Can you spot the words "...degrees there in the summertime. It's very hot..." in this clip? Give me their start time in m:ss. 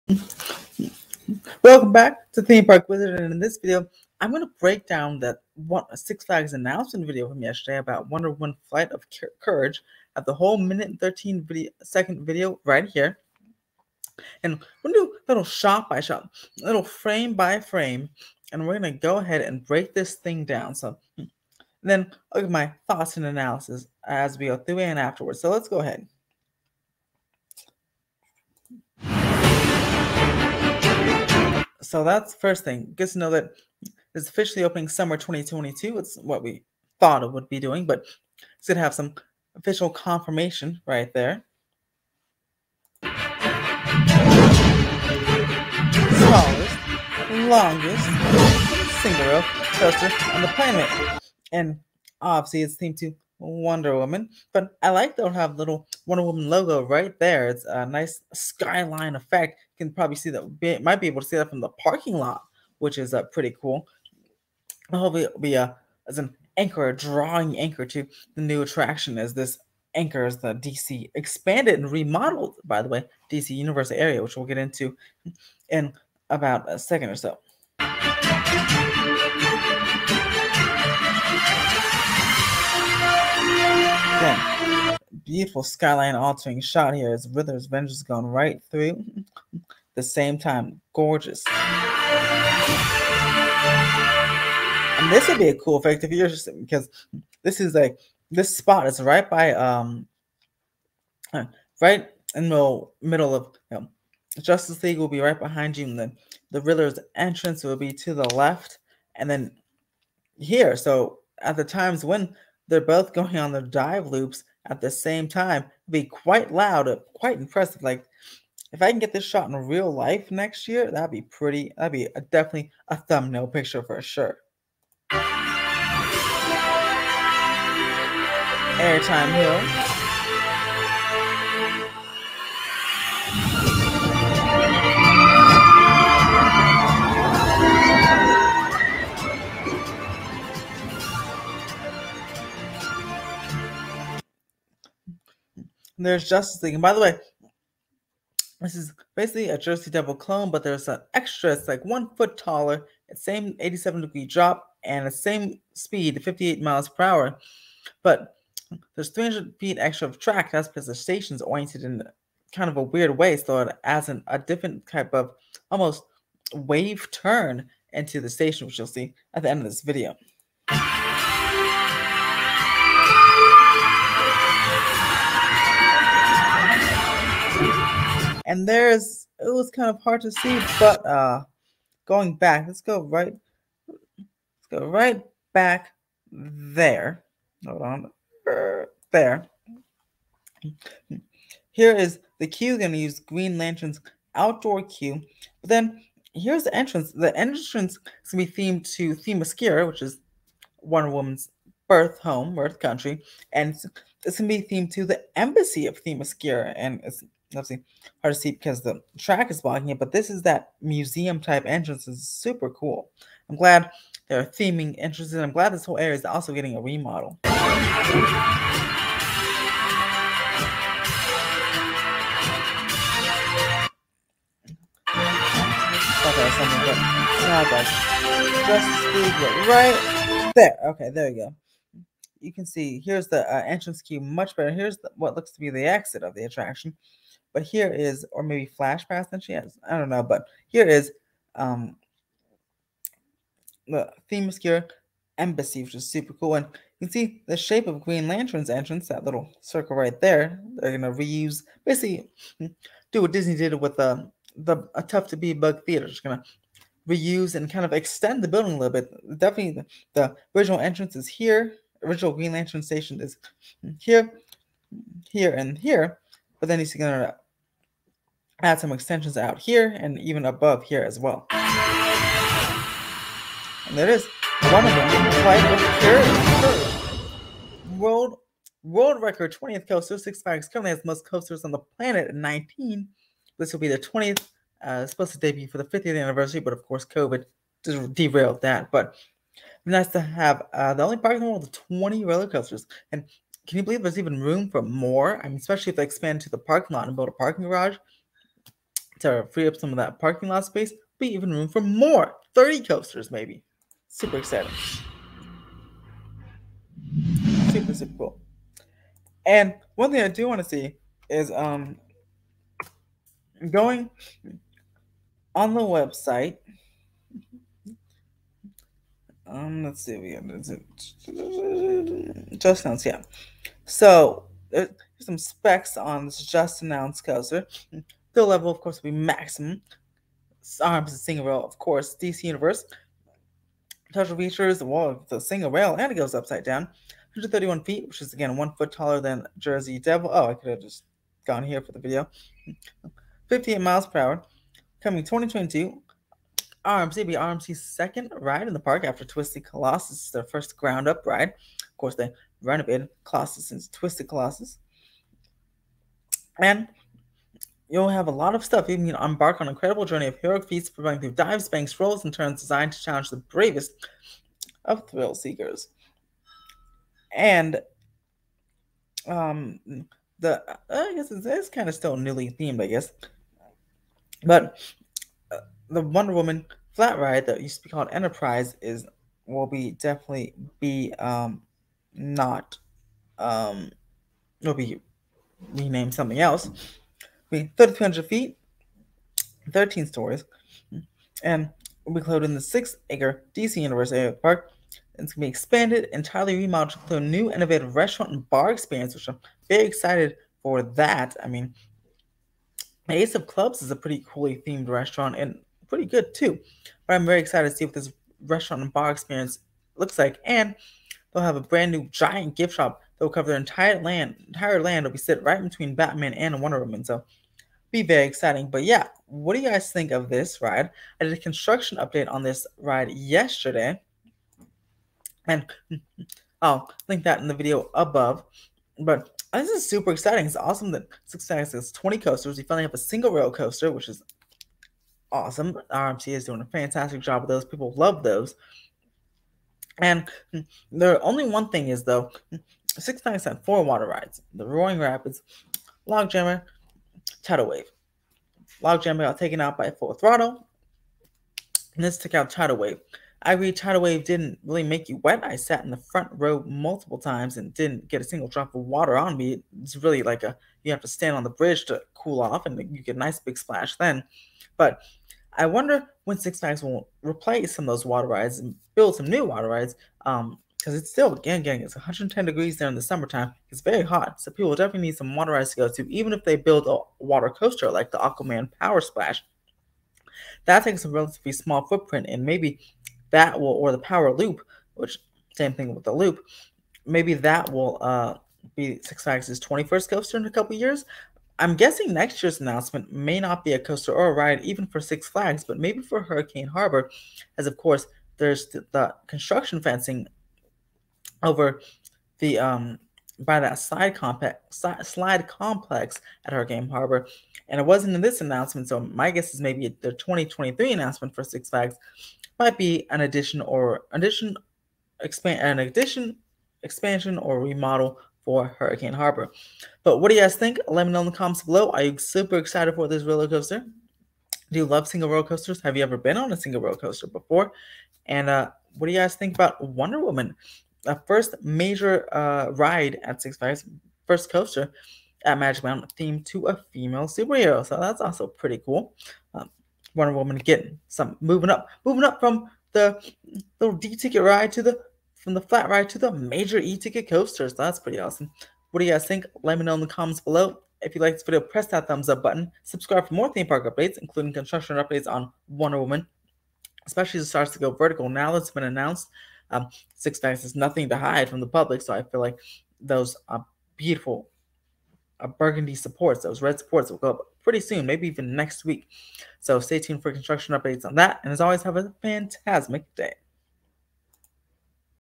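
7:52.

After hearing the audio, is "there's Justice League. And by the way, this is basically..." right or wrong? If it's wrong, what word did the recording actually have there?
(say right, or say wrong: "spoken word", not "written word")
right.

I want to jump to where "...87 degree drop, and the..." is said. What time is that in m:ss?
2:33.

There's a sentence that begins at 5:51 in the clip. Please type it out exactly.
Of course, they renovated Colossus since Twisted Colossus.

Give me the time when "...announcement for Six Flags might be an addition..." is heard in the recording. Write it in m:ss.
8:30.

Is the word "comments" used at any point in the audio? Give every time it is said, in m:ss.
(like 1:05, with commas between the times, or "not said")
8:41, 9:10.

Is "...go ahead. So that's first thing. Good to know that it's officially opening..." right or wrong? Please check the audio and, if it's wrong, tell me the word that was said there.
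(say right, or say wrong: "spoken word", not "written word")
right.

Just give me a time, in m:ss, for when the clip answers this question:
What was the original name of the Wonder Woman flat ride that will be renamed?
6:18.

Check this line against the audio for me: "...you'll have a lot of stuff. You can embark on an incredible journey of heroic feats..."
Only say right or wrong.
right.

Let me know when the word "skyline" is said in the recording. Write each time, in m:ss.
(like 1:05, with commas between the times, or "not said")
0:58, 1:25.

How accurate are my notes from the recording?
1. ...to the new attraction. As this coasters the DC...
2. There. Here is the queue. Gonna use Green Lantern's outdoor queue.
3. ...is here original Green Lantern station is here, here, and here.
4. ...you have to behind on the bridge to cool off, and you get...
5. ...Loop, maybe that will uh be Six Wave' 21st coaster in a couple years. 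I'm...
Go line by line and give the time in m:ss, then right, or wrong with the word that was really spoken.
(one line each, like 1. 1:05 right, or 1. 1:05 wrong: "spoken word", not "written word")
1. 1:07 wrong: "anchors", not "coasters"
2. 3:09 right
3. 4:21 right
4. 7:40 wrong: "stand", not "behind"
5. 8:06 wrong: "Flags", not "Wave".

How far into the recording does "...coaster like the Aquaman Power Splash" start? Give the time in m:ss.
7:57.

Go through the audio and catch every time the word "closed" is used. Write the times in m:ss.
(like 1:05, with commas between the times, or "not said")
6:32.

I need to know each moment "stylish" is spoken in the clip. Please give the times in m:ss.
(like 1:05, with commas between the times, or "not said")
not said.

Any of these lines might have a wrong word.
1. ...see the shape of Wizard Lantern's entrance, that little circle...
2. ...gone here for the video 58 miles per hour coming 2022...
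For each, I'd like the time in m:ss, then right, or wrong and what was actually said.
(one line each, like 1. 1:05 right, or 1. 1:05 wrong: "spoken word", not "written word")
1. 4:07 wrong: "Green", not "Wizard"
2. 5:41 right.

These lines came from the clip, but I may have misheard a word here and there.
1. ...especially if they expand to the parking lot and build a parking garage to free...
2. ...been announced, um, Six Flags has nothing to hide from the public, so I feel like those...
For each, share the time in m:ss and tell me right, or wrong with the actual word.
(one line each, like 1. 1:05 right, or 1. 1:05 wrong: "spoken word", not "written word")
1. 4:55 right
2. 9:18 right.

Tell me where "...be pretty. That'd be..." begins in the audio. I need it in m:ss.
2:01.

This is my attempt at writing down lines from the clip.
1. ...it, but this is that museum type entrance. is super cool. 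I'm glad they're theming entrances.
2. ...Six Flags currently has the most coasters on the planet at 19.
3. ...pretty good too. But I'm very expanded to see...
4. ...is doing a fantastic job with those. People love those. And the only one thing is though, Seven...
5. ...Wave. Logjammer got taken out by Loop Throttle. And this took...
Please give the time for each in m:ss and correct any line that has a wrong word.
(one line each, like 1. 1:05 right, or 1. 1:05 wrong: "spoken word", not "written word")
1. 3:29 right
2. 4:40 right
3. 6:45 wrong: "excited", not "expanded"
4. 7:16 wrong: "Six", not "Seven"
5. 7:27 wrong: "Full", not "Loop".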